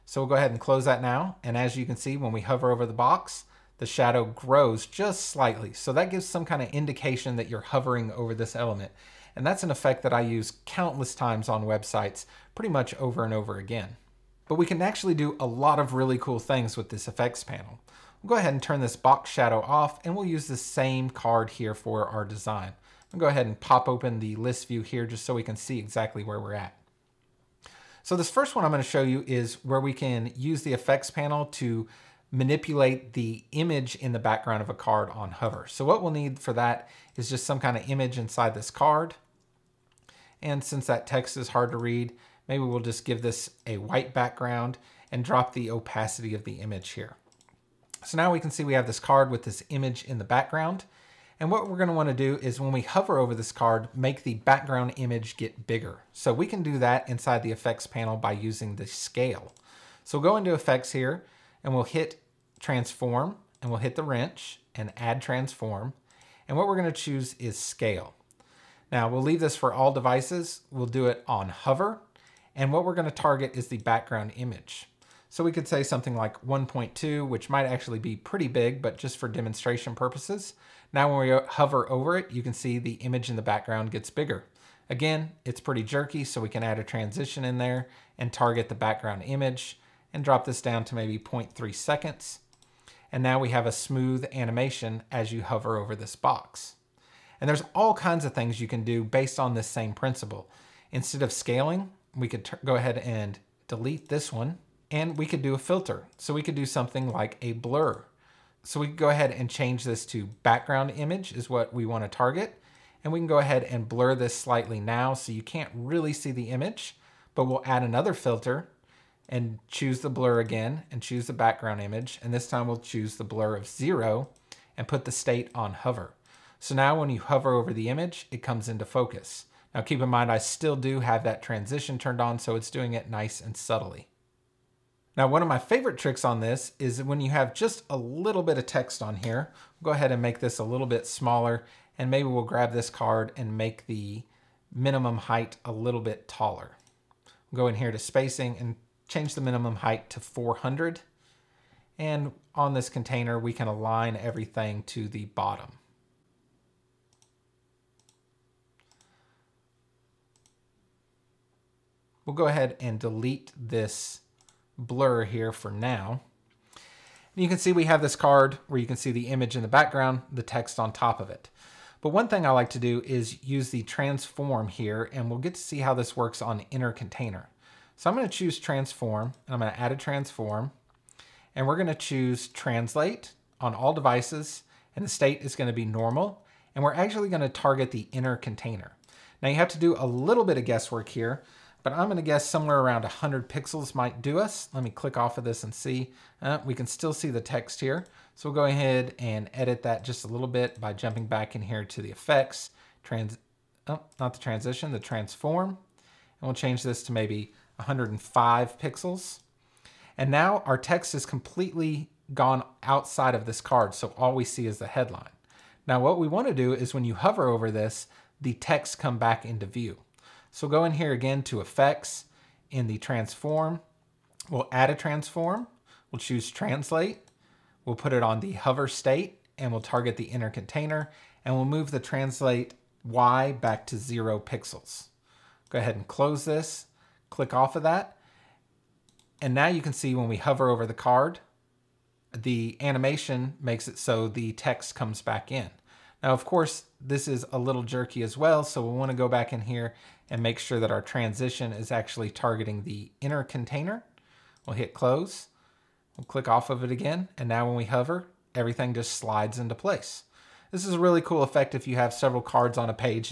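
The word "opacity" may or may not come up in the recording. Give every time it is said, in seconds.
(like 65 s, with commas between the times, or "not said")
45 s.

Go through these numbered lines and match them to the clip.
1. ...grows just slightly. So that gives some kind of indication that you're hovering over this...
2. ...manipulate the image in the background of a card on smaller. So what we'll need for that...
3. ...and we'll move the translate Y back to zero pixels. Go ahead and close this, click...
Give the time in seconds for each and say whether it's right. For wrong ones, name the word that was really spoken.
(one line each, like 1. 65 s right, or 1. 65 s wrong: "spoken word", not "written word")
1. 4 s right
2. 32 s wrong: "hover", not "smaller"
3. 231 s right.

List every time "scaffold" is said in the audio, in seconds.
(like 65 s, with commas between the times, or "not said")
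not said.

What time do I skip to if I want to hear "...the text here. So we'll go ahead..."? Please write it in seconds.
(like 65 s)
197 s.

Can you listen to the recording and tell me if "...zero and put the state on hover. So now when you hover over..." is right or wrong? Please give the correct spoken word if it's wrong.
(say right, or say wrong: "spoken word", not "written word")
right.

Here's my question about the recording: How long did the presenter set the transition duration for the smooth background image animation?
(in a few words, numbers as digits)
0.3 seconds.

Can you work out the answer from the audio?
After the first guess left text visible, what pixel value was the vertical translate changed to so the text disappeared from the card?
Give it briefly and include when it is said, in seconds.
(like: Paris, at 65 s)
105 pixels, at 207 s.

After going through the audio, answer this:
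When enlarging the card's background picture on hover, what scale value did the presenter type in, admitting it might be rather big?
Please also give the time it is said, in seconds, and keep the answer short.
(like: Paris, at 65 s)
1.2, at 76 s.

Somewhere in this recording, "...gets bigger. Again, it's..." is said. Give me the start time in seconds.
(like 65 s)
83 s.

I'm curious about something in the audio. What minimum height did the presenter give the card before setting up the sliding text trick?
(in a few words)
400.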